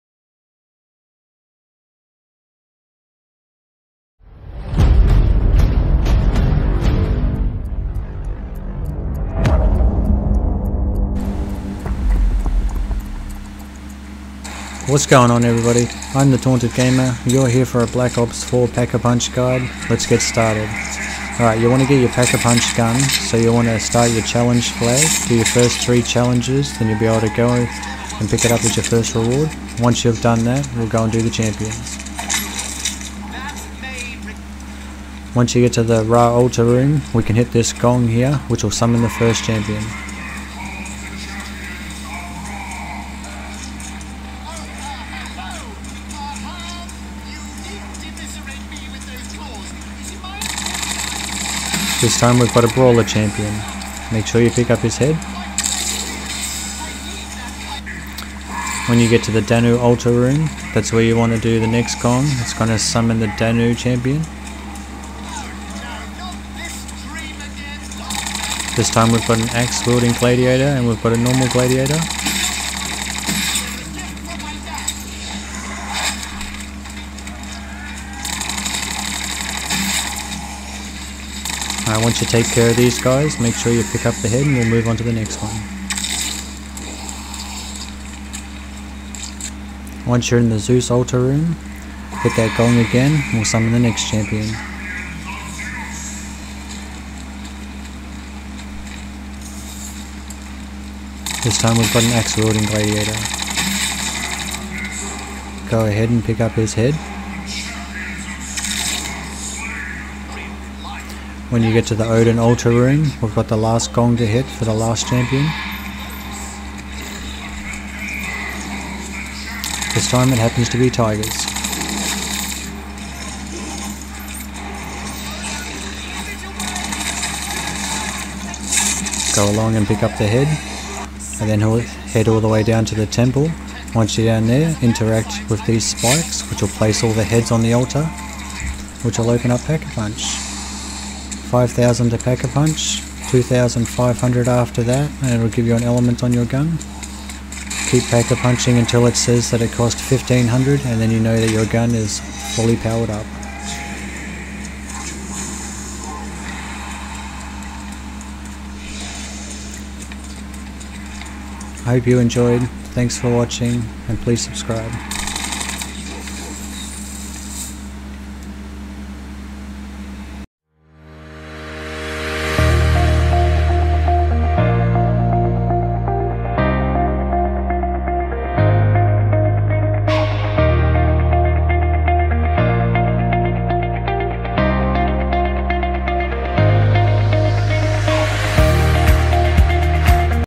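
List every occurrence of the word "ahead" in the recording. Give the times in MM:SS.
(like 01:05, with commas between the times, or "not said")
01:45.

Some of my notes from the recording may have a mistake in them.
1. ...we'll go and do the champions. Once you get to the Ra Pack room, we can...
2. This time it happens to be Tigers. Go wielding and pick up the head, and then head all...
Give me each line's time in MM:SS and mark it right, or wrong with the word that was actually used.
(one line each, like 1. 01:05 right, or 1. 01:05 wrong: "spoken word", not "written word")
1. 00:30 wrong: "Altar", not "Pack"
2. 01:59 wrong: "along", not "wielding".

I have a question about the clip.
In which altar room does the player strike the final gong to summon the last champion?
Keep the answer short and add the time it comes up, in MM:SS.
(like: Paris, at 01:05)
Odin, at 01:52.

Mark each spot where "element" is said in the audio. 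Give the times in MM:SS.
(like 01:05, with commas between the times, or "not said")
02:25.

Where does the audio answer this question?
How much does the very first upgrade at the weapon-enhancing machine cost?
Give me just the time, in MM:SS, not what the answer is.
02:21.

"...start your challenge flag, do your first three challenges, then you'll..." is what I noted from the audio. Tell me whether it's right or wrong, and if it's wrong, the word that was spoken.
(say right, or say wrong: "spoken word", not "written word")
right.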